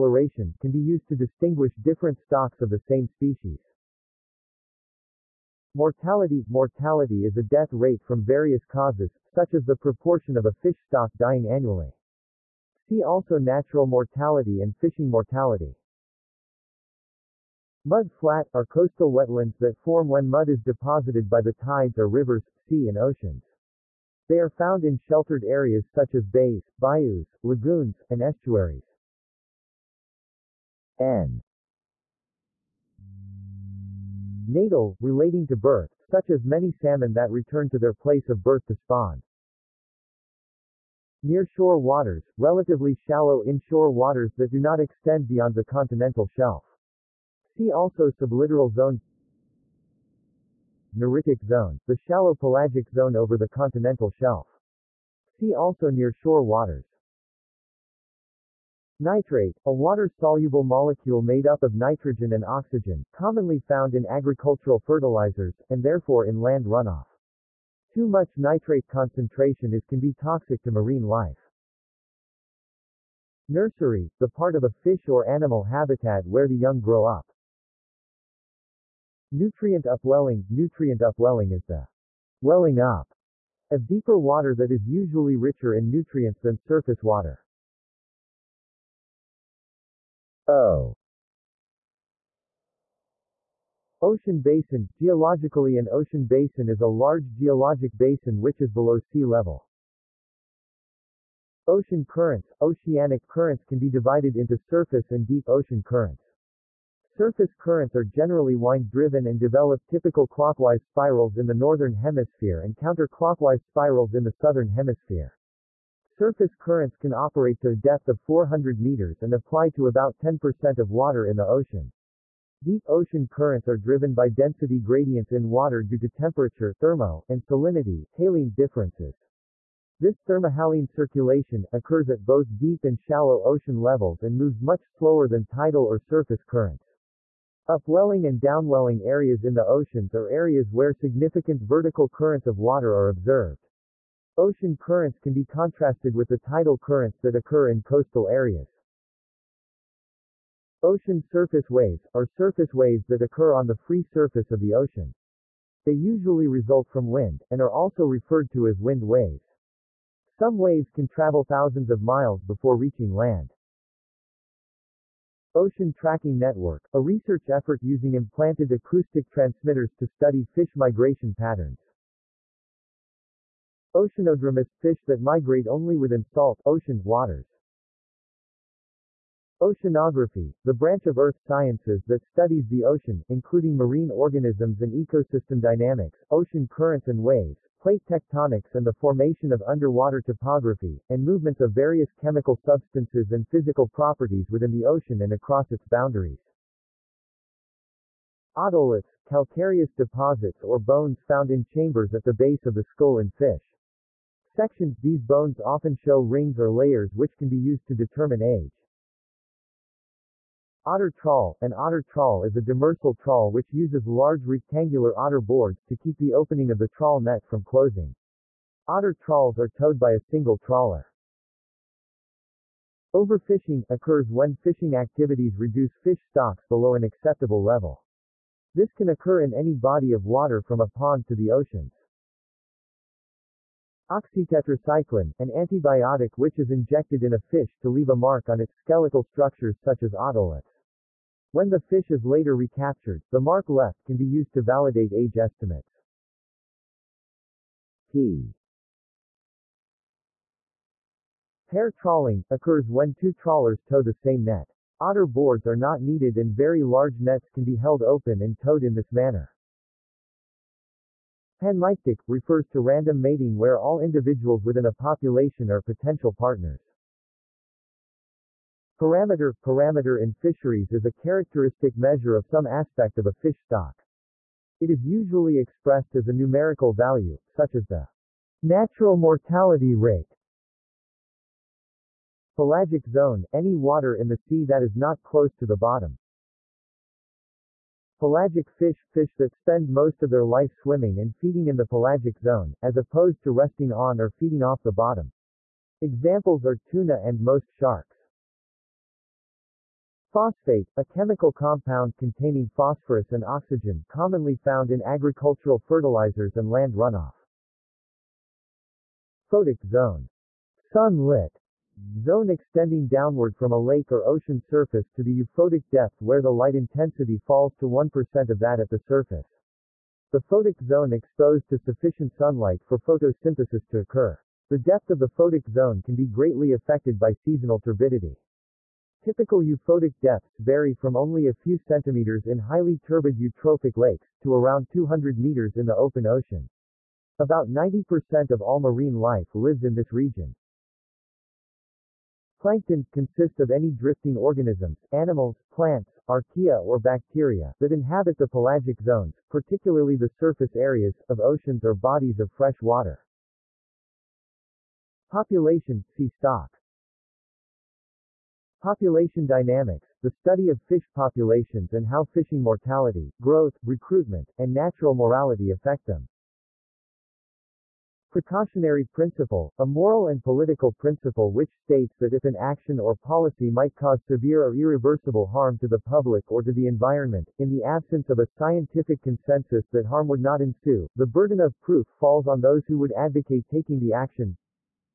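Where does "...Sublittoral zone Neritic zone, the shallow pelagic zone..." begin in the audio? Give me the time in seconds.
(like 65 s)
48 s.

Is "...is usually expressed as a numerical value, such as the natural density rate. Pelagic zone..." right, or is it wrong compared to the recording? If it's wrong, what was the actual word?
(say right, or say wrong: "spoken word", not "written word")
wrong: "mortality", not "density".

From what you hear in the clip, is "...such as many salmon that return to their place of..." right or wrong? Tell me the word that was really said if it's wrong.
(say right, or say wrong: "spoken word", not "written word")
right.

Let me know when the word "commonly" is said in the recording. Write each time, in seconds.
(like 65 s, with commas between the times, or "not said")
63 s, 304 s.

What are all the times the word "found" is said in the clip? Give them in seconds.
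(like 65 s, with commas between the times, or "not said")
24 s, 63 s, 201 s, 304 s.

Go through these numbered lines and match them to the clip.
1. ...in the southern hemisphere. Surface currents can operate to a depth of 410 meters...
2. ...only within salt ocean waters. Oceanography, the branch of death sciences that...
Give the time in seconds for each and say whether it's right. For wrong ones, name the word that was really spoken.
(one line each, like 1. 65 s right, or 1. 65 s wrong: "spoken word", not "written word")
1. 114 s wrong: "400", not "410"
2. 175 s wrong: "earth", not "death".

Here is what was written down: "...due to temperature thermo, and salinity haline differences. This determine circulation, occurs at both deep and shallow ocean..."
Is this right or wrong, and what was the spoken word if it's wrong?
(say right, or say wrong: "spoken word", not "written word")
wrong: "thermohaline", not "determine".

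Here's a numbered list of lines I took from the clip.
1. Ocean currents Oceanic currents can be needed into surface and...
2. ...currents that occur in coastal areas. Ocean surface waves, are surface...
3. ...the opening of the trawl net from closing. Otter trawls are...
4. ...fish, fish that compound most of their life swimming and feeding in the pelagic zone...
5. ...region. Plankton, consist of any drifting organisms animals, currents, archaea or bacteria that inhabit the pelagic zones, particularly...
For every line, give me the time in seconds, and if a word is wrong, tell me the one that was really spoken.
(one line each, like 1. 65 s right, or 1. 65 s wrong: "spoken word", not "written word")
1. 101 s wrong: "divided", not "needed"
2. 146 s right
3. 216 s right
4. 288 s wrong: "spend", not "compound"
5. 340 s wrong: "plants", not "currents".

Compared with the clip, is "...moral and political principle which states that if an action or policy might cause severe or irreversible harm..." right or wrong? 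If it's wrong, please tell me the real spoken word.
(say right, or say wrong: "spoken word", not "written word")
right.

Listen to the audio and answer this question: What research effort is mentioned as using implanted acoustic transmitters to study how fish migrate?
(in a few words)
Ocean Tracking Network.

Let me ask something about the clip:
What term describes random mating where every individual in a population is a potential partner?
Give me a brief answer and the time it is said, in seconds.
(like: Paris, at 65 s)
Panmictic, at 261 s.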